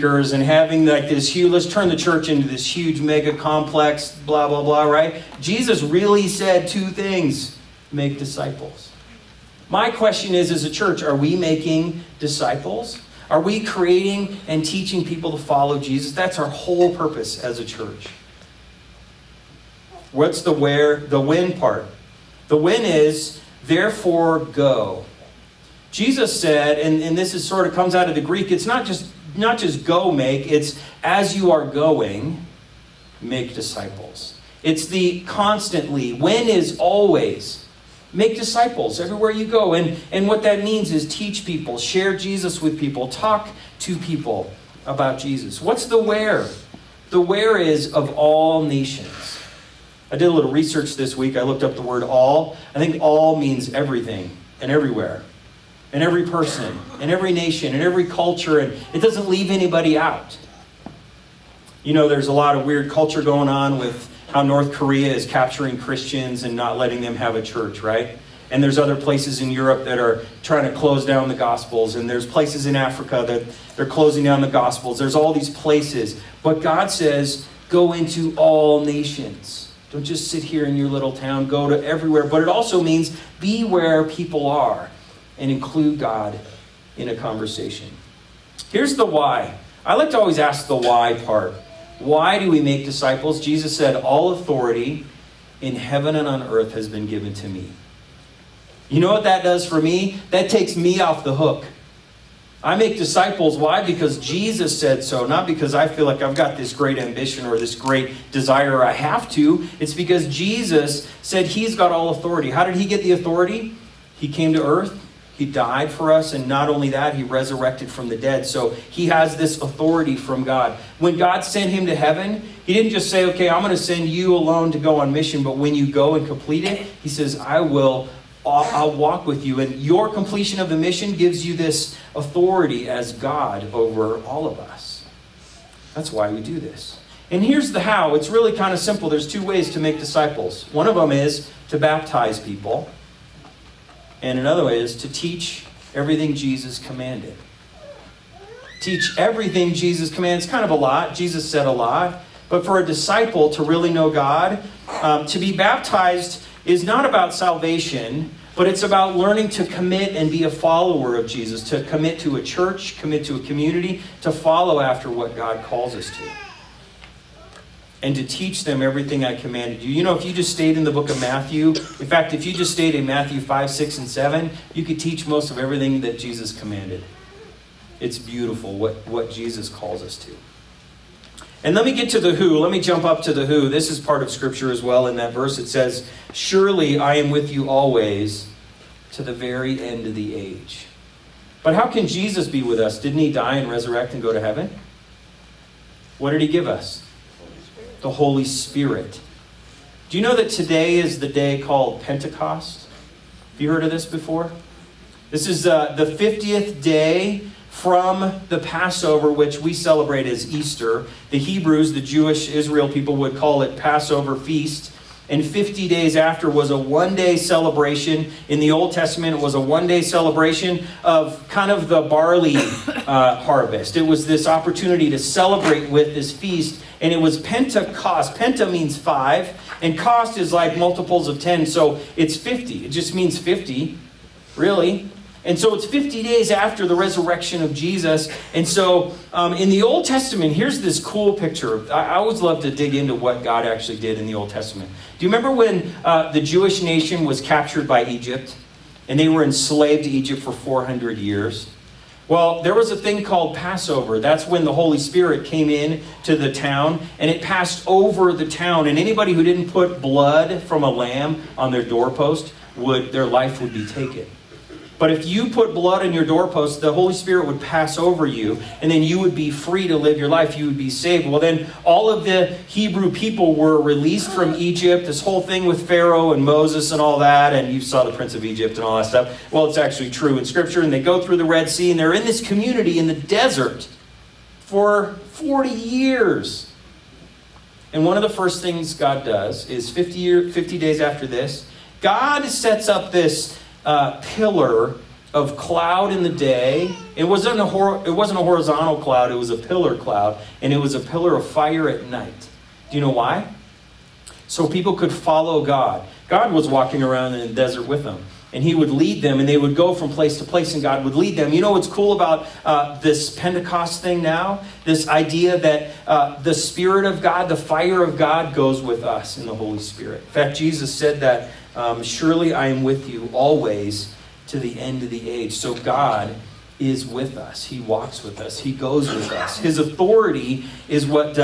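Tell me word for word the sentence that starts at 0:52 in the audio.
I think all means everything and everywhere in every person, in every nation, in every culture, and it doesn't leave anybody out.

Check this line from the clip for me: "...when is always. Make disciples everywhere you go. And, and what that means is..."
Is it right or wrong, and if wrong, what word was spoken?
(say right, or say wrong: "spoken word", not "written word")
right.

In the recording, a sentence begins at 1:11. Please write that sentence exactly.
And there's places in Africa that they're closing down the Gospels.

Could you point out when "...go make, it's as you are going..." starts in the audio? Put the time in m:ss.
0:29.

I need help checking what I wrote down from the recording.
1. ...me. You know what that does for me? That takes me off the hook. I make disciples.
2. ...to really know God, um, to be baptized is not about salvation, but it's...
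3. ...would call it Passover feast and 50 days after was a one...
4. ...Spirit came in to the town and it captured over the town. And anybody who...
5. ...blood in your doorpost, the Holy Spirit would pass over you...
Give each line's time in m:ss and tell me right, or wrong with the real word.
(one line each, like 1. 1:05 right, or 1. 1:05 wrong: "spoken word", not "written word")
1. 1:37 right
2. 2:33 right
3. 3:33 right
4. 4:14 wrong: "passed", not "captured"
5. 4:25 right.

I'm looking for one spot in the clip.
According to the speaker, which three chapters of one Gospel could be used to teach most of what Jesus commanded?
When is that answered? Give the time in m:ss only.
2:53.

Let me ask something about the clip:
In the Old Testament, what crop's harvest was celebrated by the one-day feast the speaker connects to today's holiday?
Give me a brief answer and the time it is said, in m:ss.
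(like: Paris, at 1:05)
Barley, at 3:42.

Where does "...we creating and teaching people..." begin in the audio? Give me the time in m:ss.
0:13.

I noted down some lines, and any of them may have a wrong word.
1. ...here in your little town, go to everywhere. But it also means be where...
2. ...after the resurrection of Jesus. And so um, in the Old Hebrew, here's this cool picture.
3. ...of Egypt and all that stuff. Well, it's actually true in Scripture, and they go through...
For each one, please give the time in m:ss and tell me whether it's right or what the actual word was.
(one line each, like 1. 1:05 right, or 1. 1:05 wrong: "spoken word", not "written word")
1. 1:20 right
2. 3:56 wrong: "Testament", not "Hebrew"
3. 4:38 right.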